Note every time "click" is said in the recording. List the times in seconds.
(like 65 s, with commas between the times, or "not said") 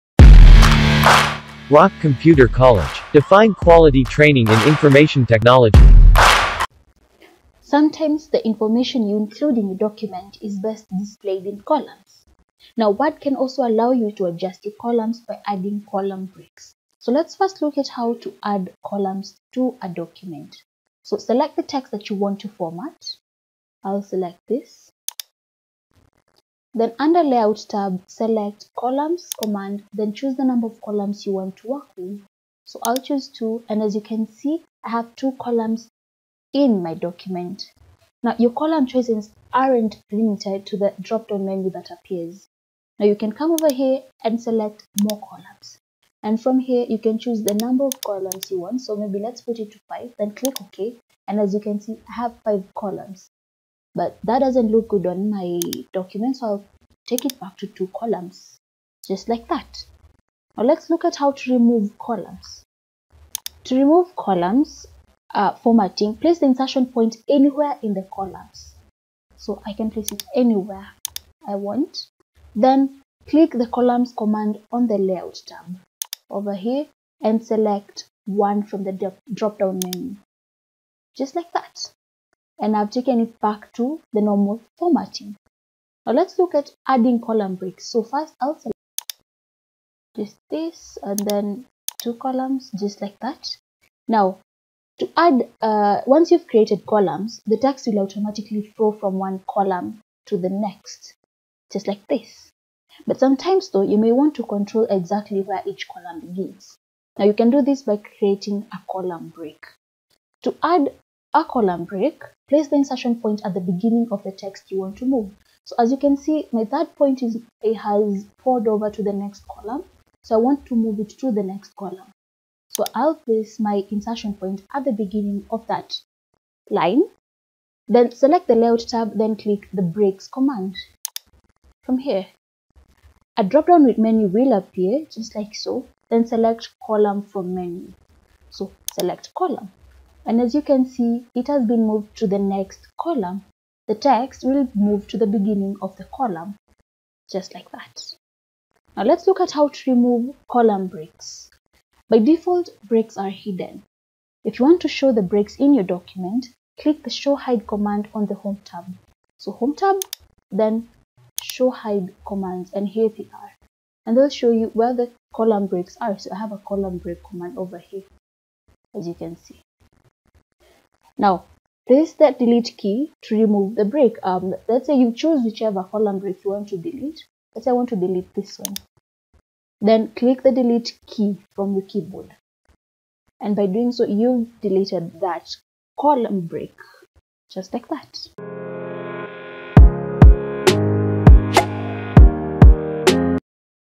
50 s, 73 s, 129 s, 156 s, 180 s.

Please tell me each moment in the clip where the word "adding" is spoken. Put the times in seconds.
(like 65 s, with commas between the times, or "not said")
15 s, 86 s.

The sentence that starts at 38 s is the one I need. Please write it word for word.
Now your column choices aren't limited to the drop-down menu that appears.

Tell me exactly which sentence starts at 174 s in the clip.
Um, let's say you choose whichever column break you want to delete.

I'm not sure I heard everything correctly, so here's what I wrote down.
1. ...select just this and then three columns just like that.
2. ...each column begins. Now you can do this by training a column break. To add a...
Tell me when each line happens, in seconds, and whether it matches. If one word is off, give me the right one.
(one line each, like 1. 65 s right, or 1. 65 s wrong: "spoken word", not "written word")
1. 88 s wrong: "two", not "three"
2. 105 s wrong: "creating", not "training".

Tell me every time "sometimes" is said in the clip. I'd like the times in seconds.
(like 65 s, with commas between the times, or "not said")
7 s, 103 s.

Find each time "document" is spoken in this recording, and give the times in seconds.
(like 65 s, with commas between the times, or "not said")
9 s, 19 s, 36 s, 55 s, 155 s.